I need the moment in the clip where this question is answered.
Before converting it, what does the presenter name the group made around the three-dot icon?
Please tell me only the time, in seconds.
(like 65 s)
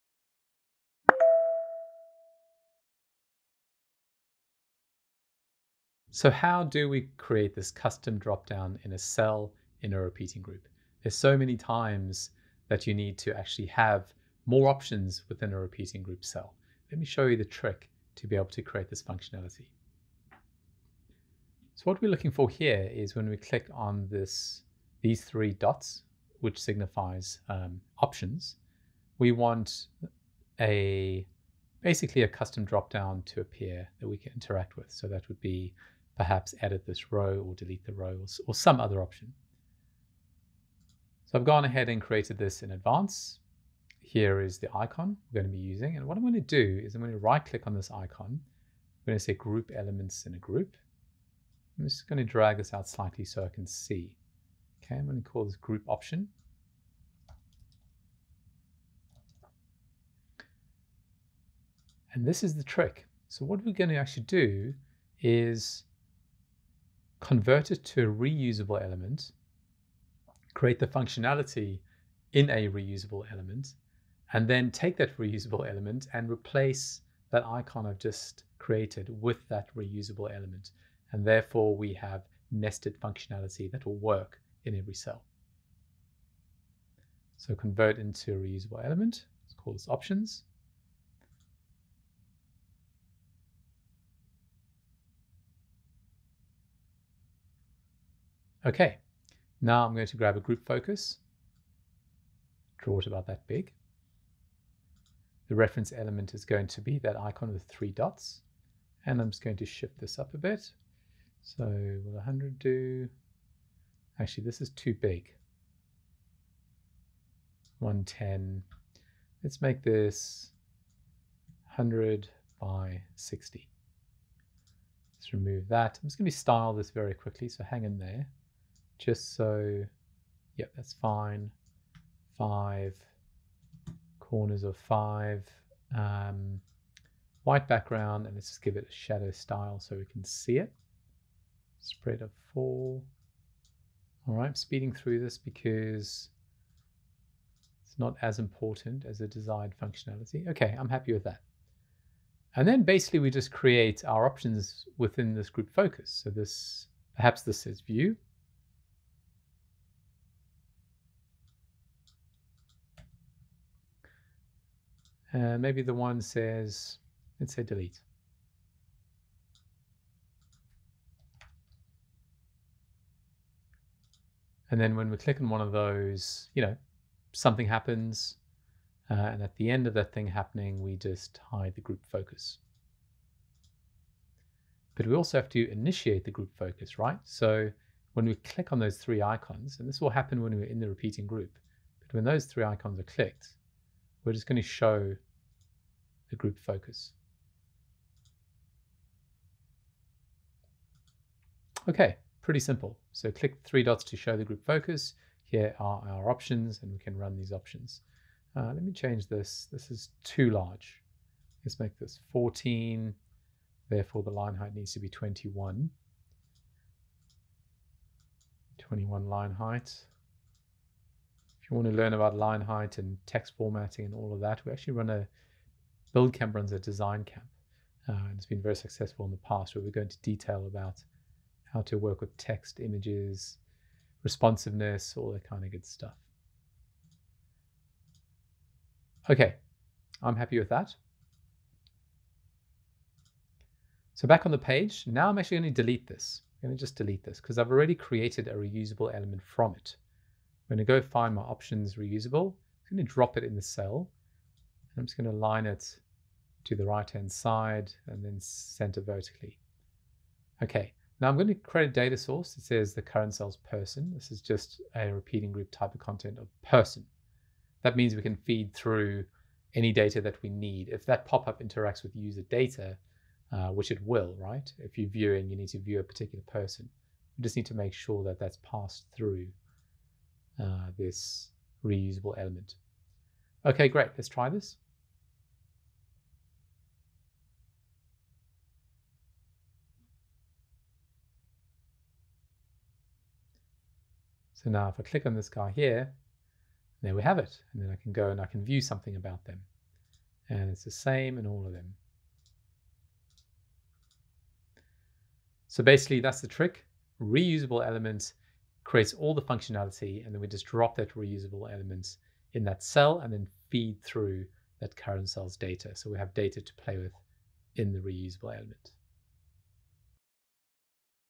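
55 s.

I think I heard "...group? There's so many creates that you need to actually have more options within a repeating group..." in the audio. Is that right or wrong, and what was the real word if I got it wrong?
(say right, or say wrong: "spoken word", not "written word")
wrong: "times", not "creates".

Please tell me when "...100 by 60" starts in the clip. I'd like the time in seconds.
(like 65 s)
121 s.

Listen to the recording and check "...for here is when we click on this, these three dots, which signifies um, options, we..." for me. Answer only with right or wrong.
right.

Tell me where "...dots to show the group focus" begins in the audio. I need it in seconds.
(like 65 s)
203 s.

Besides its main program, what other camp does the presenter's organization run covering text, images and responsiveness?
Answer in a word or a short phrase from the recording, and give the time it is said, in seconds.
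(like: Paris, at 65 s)
design camp, at 226 s.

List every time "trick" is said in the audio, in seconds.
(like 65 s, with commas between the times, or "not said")
17 s, 62 s, 306 s.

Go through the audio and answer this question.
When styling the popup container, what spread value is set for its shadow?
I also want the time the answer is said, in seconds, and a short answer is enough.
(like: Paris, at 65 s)
4, at 141 s.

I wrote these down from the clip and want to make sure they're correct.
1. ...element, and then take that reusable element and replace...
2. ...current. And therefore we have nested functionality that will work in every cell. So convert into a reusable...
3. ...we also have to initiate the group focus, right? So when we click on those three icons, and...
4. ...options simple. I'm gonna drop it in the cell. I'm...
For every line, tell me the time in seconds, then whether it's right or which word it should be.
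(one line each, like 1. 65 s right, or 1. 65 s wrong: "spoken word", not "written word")
1. 73 s right
2. 80 s wrong: "element", not "current"
3. 185 s right
4. 251 s wrong: "reusable", not "simple".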